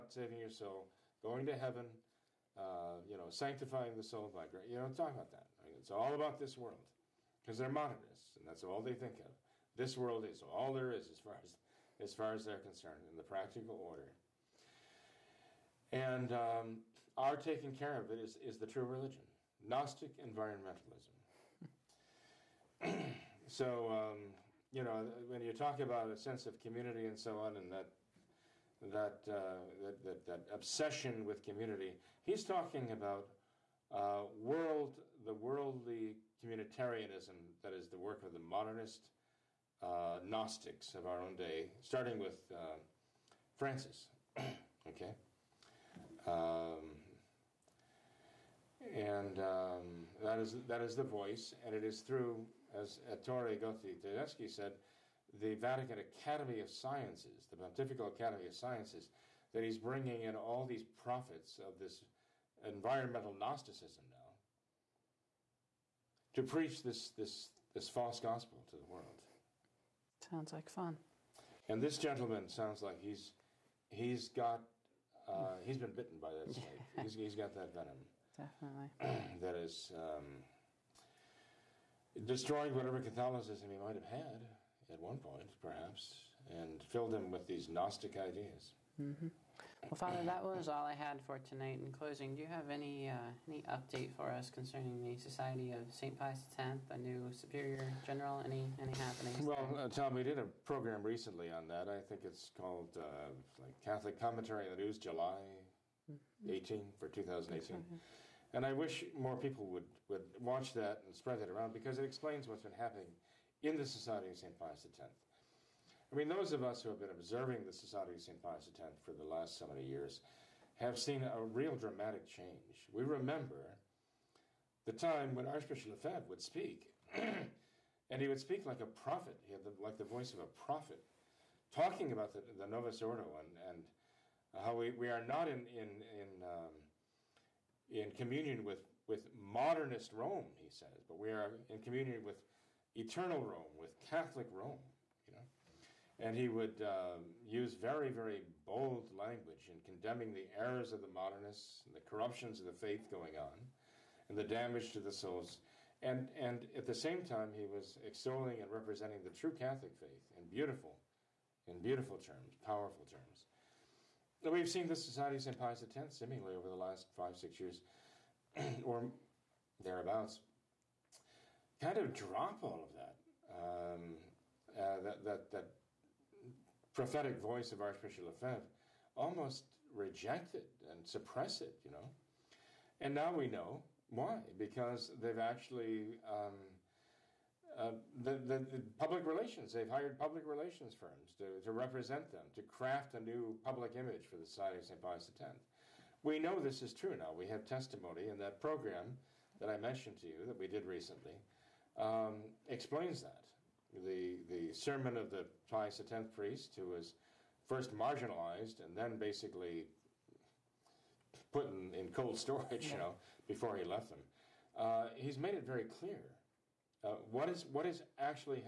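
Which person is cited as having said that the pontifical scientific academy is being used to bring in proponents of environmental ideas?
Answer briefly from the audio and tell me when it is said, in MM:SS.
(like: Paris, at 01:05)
Ettore Gotti Tedeschi, at 00:52.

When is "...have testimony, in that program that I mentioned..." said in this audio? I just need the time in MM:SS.
03:17.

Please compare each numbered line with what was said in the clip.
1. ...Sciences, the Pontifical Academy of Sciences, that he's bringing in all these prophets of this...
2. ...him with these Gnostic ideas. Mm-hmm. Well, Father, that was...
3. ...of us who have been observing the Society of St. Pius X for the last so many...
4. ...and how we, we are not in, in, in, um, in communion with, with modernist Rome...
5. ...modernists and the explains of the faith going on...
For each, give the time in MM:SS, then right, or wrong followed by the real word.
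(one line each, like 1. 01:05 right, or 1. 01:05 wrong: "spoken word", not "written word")
1. 00:56 right
2. 01:27 right
3. 01:56 right
4. 02:13 right
5. 02:31 wrong: "corruptions", not "explains".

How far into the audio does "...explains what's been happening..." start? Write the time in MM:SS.
01:52.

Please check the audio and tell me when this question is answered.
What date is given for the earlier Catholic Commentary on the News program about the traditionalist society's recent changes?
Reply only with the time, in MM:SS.
01:44.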